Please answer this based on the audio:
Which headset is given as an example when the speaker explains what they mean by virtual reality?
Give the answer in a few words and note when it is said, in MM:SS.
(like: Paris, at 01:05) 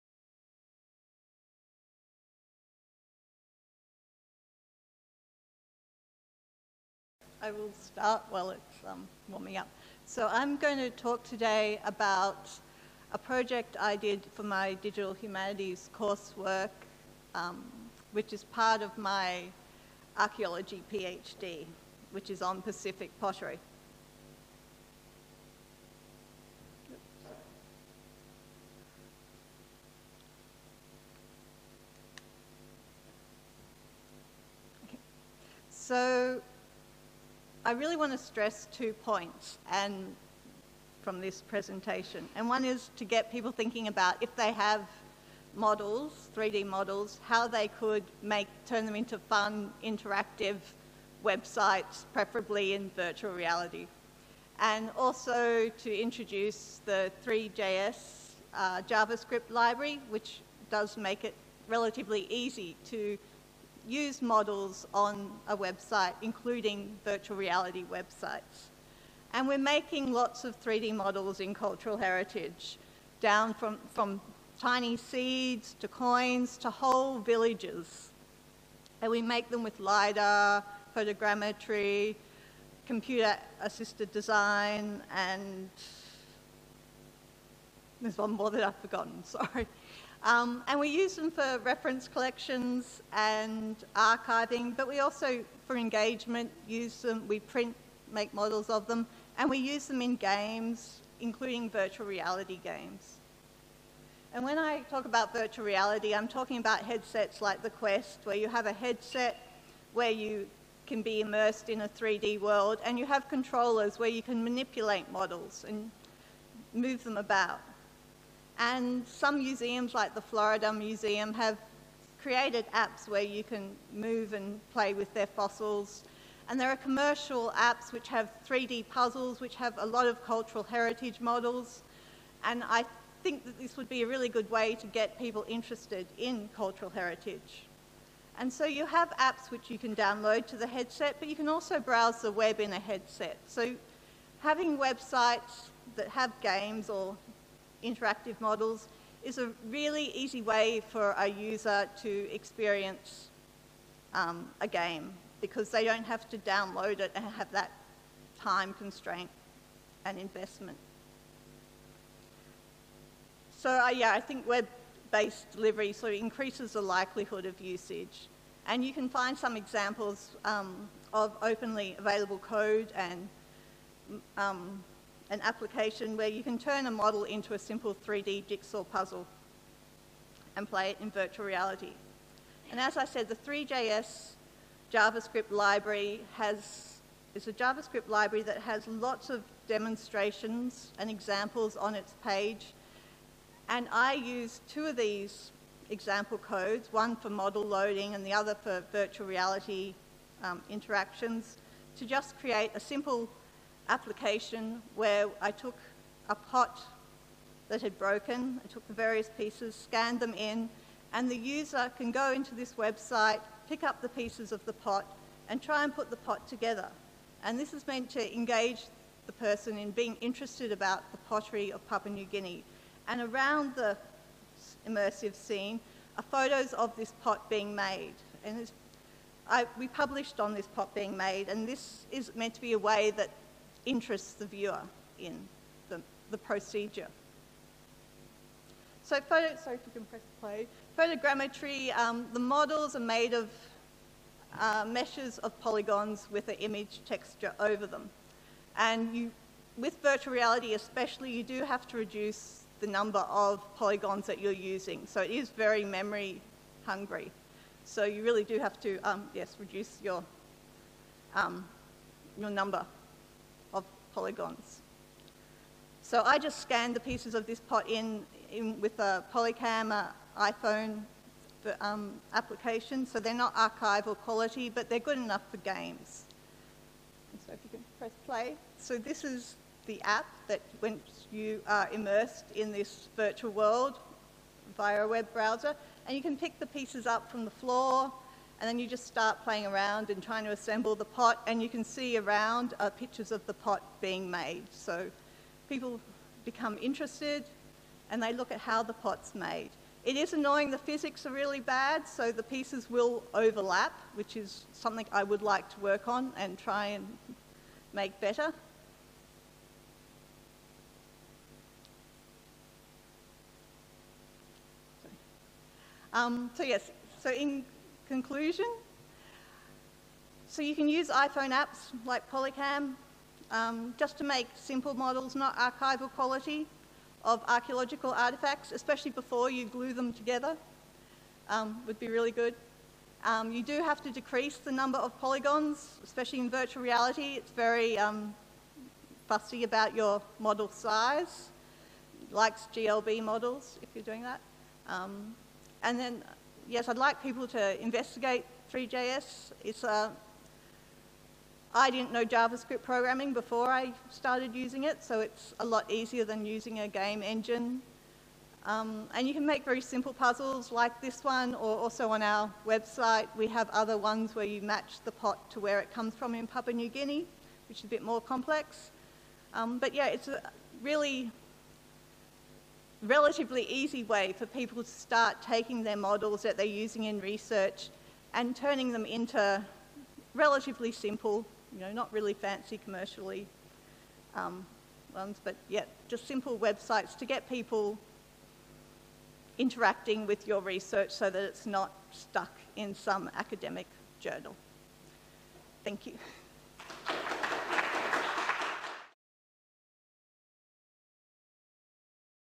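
Quest, at 01:47.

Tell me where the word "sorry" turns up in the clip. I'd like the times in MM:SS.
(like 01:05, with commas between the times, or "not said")
01:29, 03:59.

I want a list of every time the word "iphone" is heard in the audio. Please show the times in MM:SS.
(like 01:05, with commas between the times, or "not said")
04:30, 05:21.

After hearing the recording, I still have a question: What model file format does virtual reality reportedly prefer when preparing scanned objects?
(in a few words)
GLB.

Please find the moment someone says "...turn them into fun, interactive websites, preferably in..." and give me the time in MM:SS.
00:48.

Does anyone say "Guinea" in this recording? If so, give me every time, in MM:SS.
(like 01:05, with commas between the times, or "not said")
03:42, 06:06.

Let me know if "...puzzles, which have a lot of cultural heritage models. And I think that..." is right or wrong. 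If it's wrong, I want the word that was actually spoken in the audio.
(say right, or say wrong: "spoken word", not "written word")
right.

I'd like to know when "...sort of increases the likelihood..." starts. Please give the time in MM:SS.
02:45.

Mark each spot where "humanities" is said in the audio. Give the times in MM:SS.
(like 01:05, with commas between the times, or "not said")
00:15.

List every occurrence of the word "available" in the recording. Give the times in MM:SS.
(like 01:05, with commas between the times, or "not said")
02:51.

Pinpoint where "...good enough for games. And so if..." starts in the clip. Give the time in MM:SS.
04:34.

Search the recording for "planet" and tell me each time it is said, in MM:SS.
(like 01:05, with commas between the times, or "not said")
not said.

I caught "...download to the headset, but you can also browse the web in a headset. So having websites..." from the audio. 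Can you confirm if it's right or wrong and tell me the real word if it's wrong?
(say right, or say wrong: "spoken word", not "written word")
right.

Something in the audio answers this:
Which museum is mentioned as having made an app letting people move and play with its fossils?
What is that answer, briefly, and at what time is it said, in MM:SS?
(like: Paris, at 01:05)
Florida Museum, at 02:00.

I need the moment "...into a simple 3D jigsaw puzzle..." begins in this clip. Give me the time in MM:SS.
02:57.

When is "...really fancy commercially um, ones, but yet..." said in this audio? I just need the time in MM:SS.
06:22.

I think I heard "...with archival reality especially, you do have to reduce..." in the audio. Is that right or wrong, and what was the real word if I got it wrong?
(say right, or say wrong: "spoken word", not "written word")
wrong: "virtual", not "archival".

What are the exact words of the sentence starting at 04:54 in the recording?
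So people become interested, and they look at how the pot's made.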